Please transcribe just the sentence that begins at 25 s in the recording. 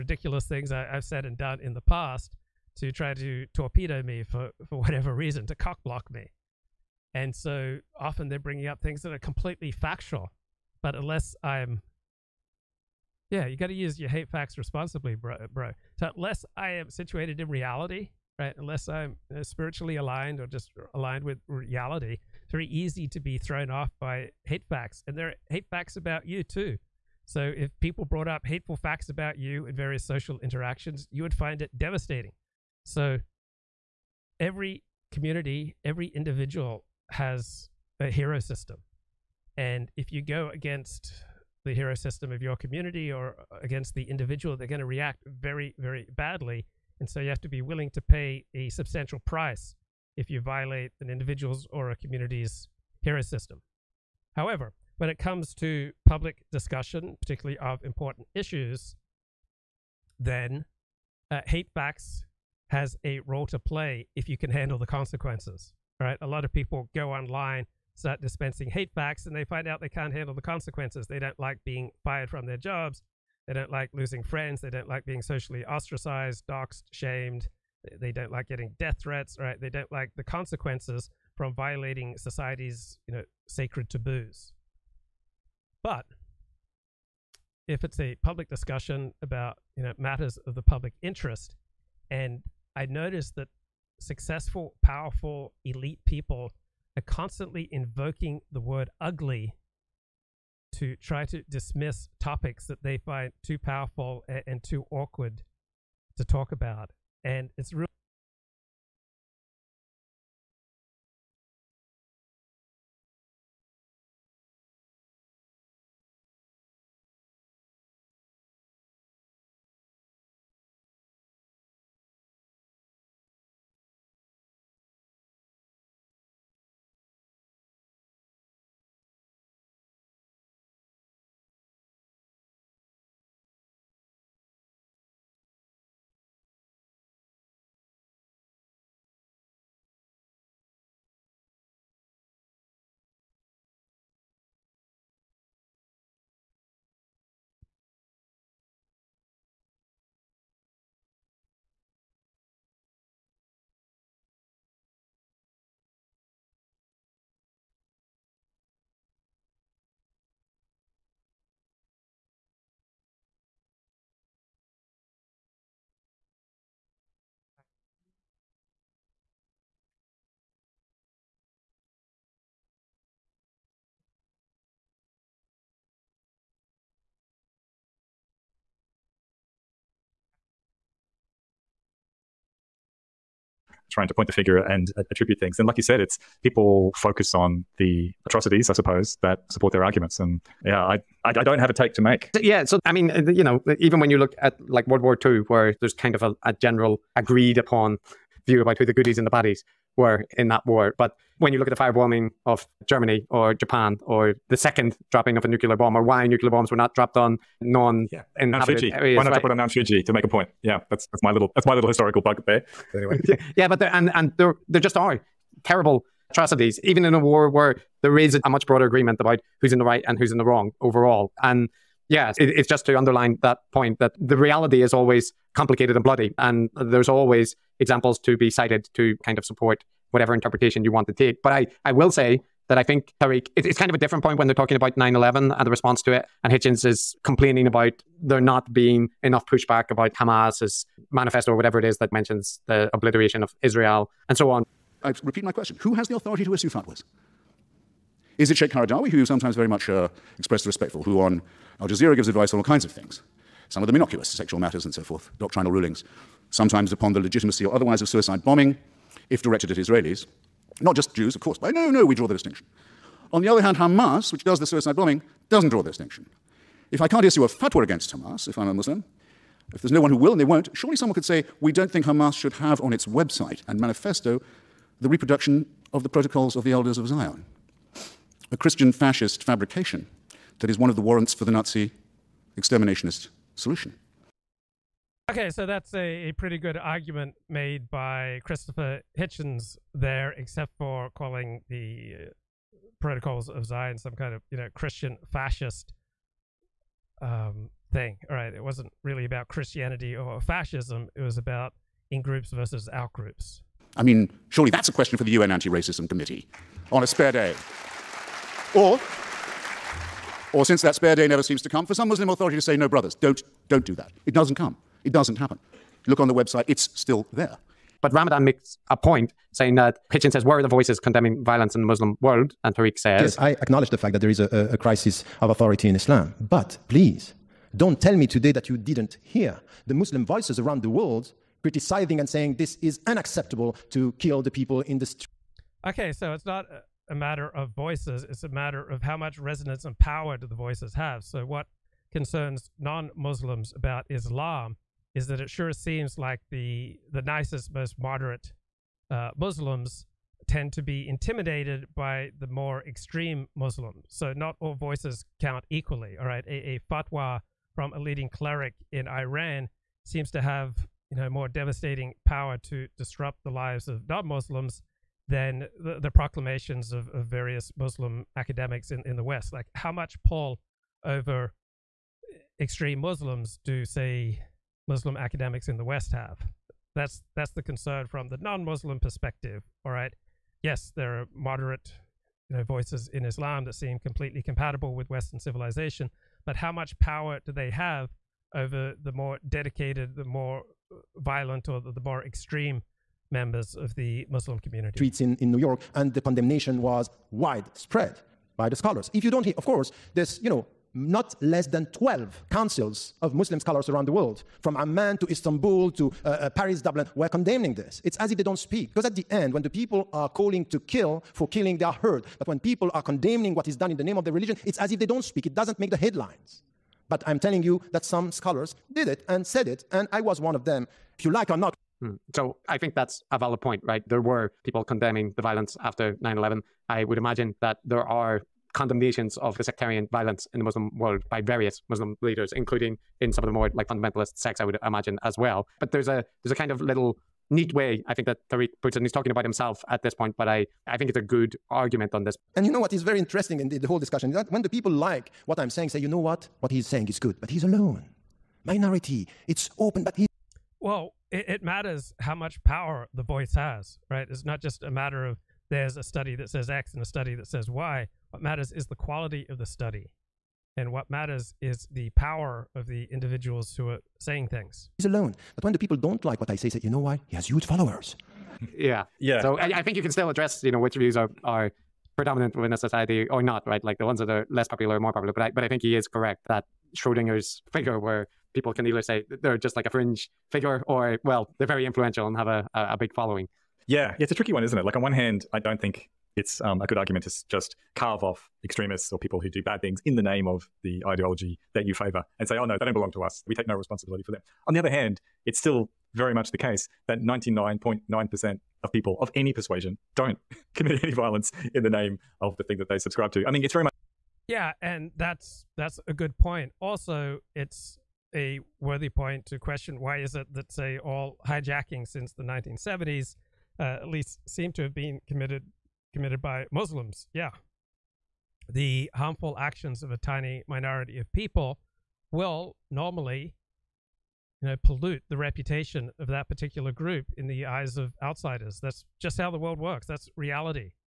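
And there are hate facts about you too.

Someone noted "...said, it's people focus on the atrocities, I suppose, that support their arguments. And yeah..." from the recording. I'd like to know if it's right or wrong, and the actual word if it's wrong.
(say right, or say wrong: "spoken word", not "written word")
right.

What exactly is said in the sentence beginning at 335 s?
Okay, so it's not a matter of voices, it's a matter of how much resonance and power do the voices have.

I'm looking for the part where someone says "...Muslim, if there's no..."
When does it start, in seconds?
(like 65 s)
268 s.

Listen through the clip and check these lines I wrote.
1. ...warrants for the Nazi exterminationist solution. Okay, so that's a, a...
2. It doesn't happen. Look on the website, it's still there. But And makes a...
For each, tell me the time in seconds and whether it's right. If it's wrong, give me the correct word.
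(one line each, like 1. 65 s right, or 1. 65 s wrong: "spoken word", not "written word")
1. 281 s right
2. 315 s wrong: "Ramadan", not "And".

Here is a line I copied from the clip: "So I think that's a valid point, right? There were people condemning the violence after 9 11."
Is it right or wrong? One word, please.
right.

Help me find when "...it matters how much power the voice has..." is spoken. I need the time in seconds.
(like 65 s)
451 s.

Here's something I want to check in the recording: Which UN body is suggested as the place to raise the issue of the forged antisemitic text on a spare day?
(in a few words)
UN Anti Racism Committee.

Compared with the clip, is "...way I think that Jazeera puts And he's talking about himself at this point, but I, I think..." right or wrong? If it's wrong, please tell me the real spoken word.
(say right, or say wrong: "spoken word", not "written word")
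wrong: "Tariq", not "Jazeera".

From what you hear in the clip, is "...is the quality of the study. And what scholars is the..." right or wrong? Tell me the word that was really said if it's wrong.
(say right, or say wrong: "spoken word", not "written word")
wrong: "matters", not "scholars".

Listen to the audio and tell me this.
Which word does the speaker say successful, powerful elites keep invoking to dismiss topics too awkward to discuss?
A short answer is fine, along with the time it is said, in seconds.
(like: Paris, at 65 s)
ugly, at 99 s.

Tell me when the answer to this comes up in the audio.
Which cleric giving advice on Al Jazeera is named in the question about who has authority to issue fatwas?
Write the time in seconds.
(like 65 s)
248 s.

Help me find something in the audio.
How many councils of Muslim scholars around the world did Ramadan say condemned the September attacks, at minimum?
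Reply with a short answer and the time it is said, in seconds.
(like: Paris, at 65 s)
12, at 401 s.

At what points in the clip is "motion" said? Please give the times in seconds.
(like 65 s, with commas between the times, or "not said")
not said.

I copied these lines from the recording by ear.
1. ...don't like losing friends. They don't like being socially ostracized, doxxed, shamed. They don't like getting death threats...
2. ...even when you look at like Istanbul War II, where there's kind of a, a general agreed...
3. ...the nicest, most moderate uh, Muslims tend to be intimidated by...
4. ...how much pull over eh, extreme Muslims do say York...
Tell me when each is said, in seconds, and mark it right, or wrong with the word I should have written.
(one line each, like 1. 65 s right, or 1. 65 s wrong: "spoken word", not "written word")
1. 73 s right
2. 193 s wrong: "World", not "Istanbul"
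3. 347 s right
4. 369 s wrong: "Muslim", not "York".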